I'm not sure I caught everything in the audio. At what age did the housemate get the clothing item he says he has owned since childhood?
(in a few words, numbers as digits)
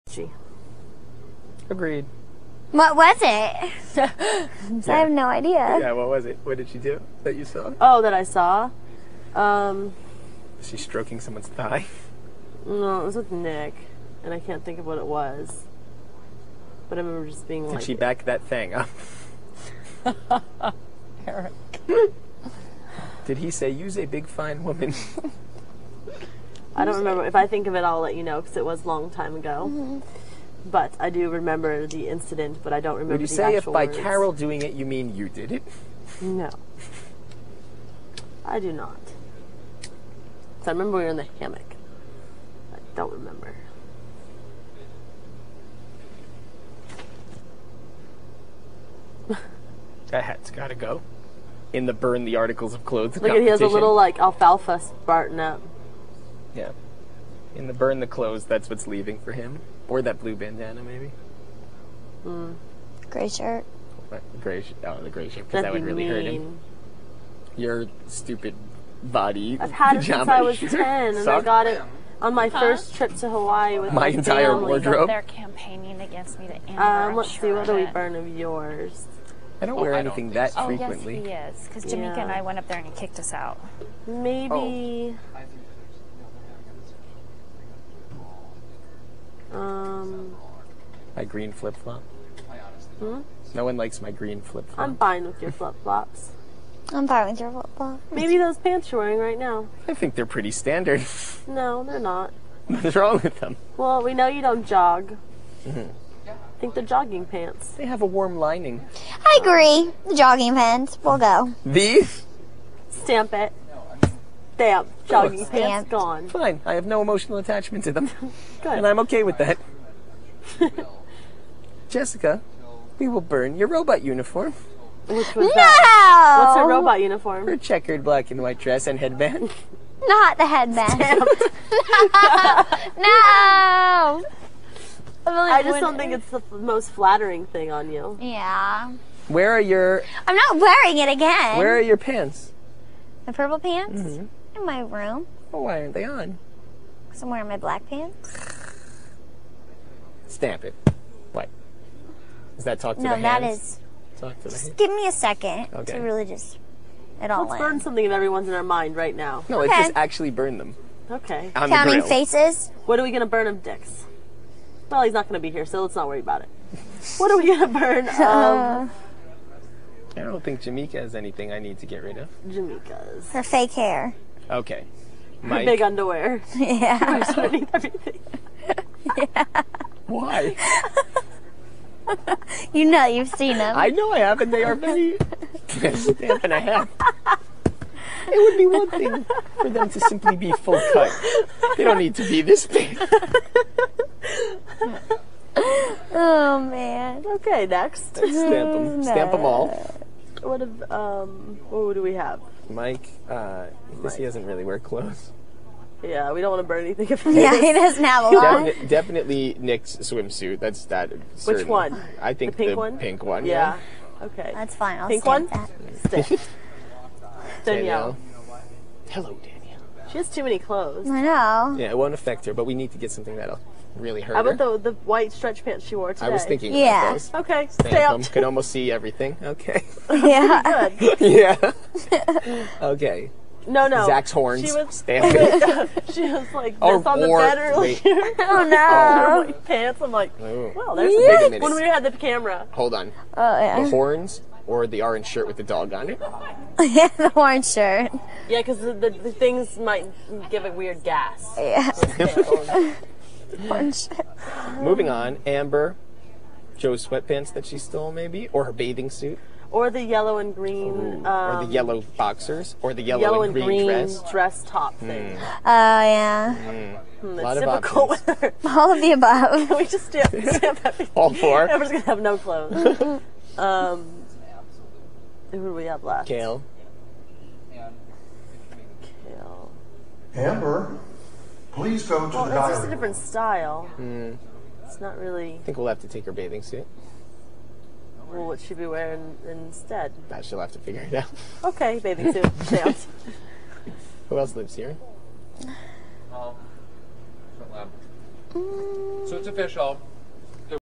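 10.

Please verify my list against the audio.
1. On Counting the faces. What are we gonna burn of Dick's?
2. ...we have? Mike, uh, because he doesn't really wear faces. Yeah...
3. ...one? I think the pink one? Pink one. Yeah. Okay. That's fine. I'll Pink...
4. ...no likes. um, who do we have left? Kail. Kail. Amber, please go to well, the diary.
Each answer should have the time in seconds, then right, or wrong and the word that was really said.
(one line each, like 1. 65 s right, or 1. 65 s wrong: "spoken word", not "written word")
1. 161 s right
2. 202 s wrong: "clothes", not "faces"
3. 211 s right
4. 272 s wrong: "clothes", not "likes".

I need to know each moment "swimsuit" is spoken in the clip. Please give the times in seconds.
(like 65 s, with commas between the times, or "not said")
209 s.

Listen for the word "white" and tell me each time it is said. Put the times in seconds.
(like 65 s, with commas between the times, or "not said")
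128 s, 224 s.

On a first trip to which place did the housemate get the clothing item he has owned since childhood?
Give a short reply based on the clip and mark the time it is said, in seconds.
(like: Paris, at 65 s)
Hawaii, at 72 s.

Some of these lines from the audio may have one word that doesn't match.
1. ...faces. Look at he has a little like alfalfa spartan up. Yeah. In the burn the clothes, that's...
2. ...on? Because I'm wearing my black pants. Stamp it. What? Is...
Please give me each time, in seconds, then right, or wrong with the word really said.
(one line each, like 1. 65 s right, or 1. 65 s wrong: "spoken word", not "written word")
1. 52 s wrong: "clothes", not "faces"
2. 146 s right.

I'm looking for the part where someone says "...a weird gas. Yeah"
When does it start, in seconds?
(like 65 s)
250 s.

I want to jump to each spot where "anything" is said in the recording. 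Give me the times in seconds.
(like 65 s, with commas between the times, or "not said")
79 s, 171 s, 206 s.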